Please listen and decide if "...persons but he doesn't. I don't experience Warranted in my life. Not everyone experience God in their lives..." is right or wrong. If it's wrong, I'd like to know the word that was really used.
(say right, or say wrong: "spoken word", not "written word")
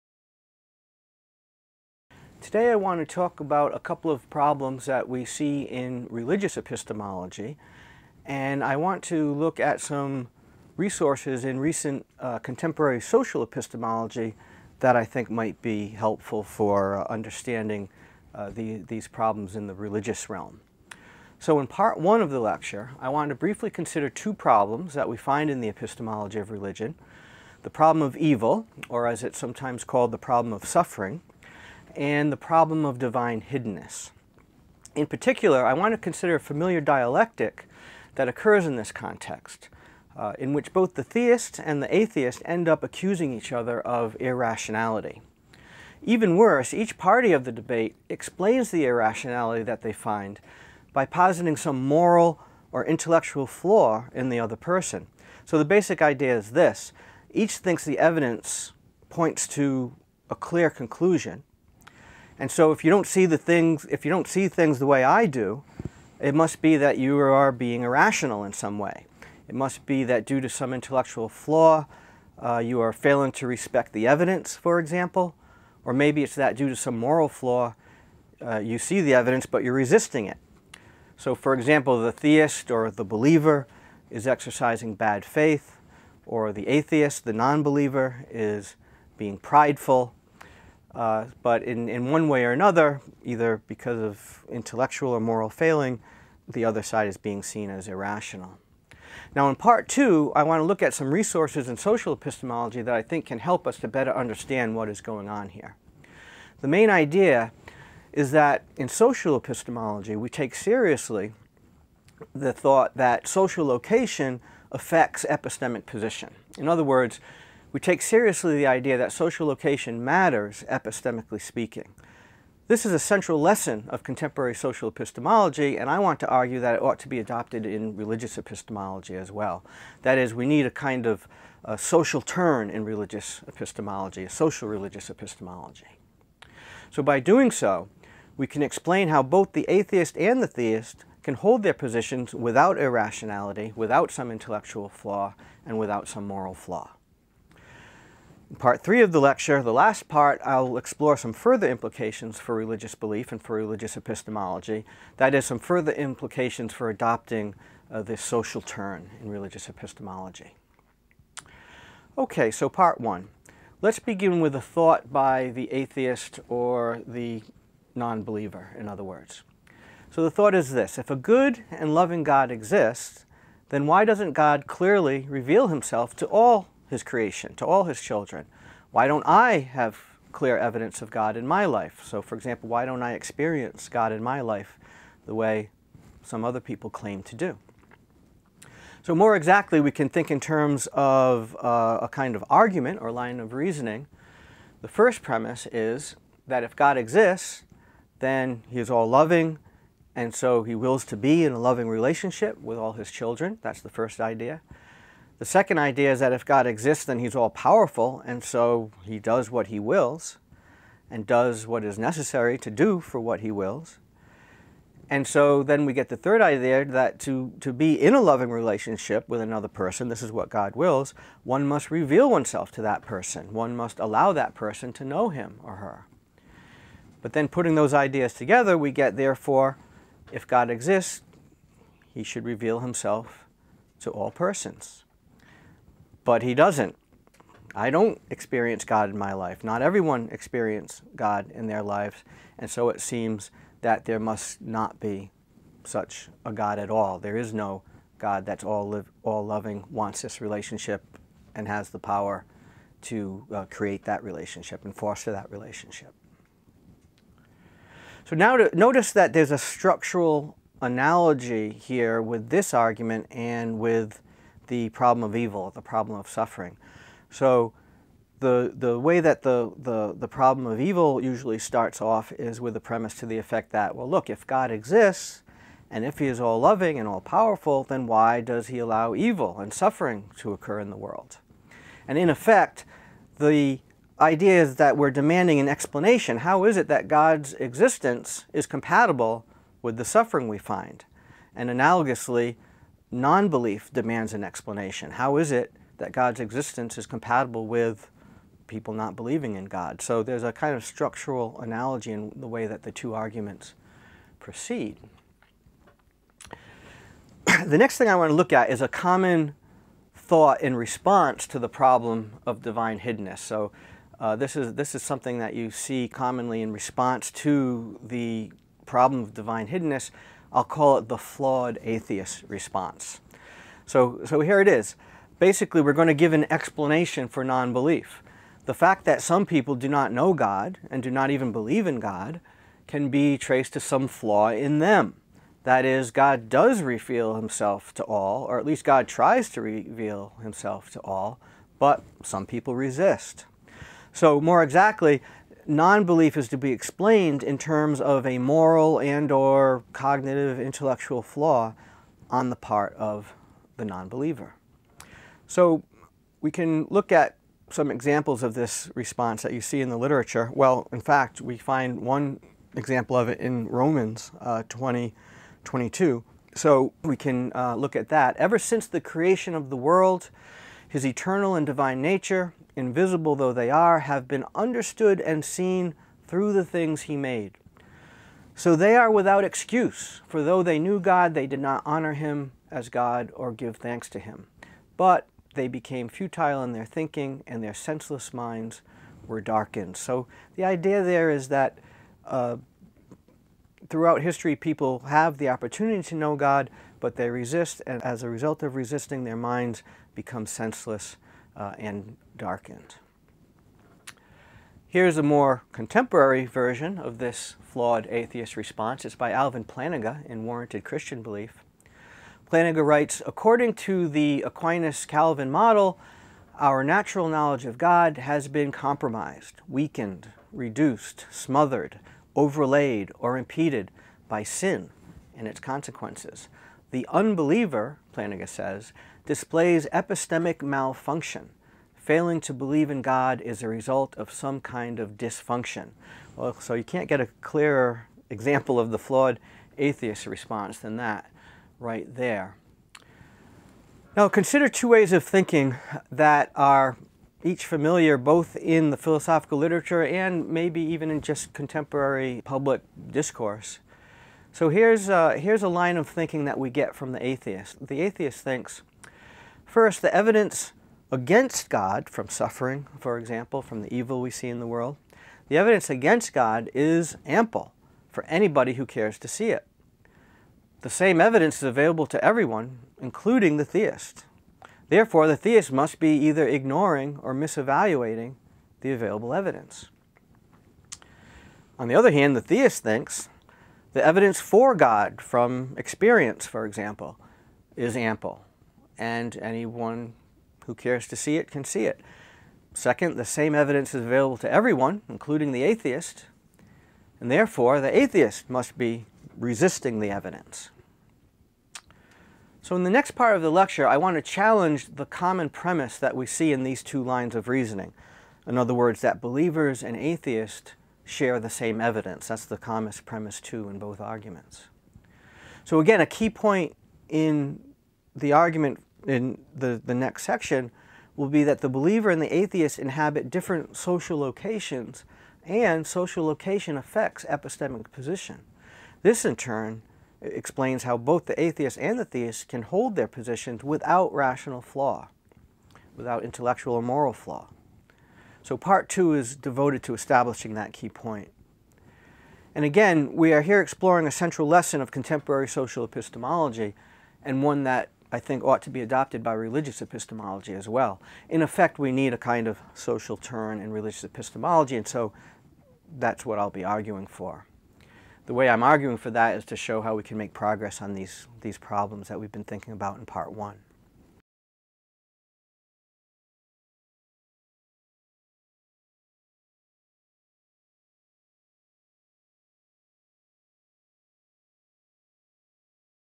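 wrong: "God", not "Warranted".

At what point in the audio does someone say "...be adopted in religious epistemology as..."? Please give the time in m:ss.
2:07.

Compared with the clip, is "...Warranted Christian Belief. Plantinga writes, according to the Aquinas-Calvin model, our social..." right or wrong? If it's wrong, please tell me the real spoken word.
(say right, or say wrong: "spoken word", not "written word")
wrong: "natural", not "social".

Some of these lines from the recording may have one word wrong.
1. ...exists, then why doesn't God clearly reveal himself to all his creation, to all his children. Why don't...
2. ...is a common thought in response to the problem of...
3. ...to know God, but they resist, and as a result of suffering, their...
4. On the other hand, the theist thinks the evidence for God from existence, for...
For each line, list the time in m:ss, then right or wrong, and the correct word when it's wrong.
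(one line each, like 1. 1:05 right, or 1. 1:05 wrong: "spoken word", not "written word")
1. 2:52 right
2. 5:08 right
3. 6:36 wrong: "resisting", not "suffering"
4. 8:01 wrong: "experience", not "existence".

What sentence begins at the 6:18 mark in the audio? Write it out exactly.
So they are without excuse, for though they knew God, they did not honor him as God or give thanks to him.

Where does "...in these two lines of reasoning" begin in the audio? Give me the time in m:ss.
8:26.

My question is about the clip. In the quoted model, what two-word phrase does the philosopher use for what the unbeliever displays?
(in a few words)
Epistemic malfunction.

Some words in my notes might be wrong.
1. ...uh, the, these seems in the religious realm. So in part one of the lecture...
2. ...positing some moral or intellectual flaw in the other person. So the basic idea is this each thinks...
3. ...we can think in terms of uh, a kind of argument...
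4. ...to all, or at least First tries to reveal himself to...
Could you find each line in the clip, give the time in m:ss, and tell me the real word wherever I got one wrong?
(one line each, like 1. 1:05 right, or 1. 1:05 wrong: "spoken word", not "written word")
1. 0:18 wrong: "problems", not "seems"
2. 0:51 right
3. 3:09 right
4. 5:37 wrong: "God", not "First".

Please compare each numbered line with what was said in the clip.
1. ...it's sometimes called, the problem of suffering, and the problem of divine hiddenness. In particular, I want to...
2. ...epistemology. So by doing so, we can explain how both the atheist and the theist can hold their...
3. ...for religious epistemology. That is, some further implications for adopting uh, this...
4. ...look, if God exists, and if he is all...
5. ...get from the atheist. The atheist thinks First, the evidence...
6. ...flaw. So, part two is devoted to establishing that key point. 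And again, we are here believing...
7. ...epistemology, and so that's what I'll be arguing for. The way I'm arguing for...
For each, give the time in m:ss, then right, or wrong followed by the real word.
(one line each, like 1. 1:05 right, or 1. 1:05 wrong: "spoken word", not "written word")
1. 0:29 right
2. 2:15 right
3. 2:33 right
4. 4:34 right
5. 7:36 right
6. 8:57 wrong: "exploring", not "believing"
7. 9:14 right.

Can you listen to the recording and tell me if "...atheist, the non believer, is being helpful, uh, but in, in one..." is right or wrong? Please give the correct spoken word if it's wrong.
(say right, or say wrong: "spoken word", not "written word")
wrong: "prideful", not "helpful".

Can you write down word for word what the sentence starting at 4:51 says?
And analogously, non-belief demands an explanation.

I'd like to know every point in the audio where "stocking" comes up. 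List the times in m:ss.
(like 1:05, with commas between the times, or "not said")
not said.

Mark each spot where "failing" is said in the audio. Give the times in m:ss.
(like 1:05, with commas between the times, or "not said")
1:12, 1:35, 7:11.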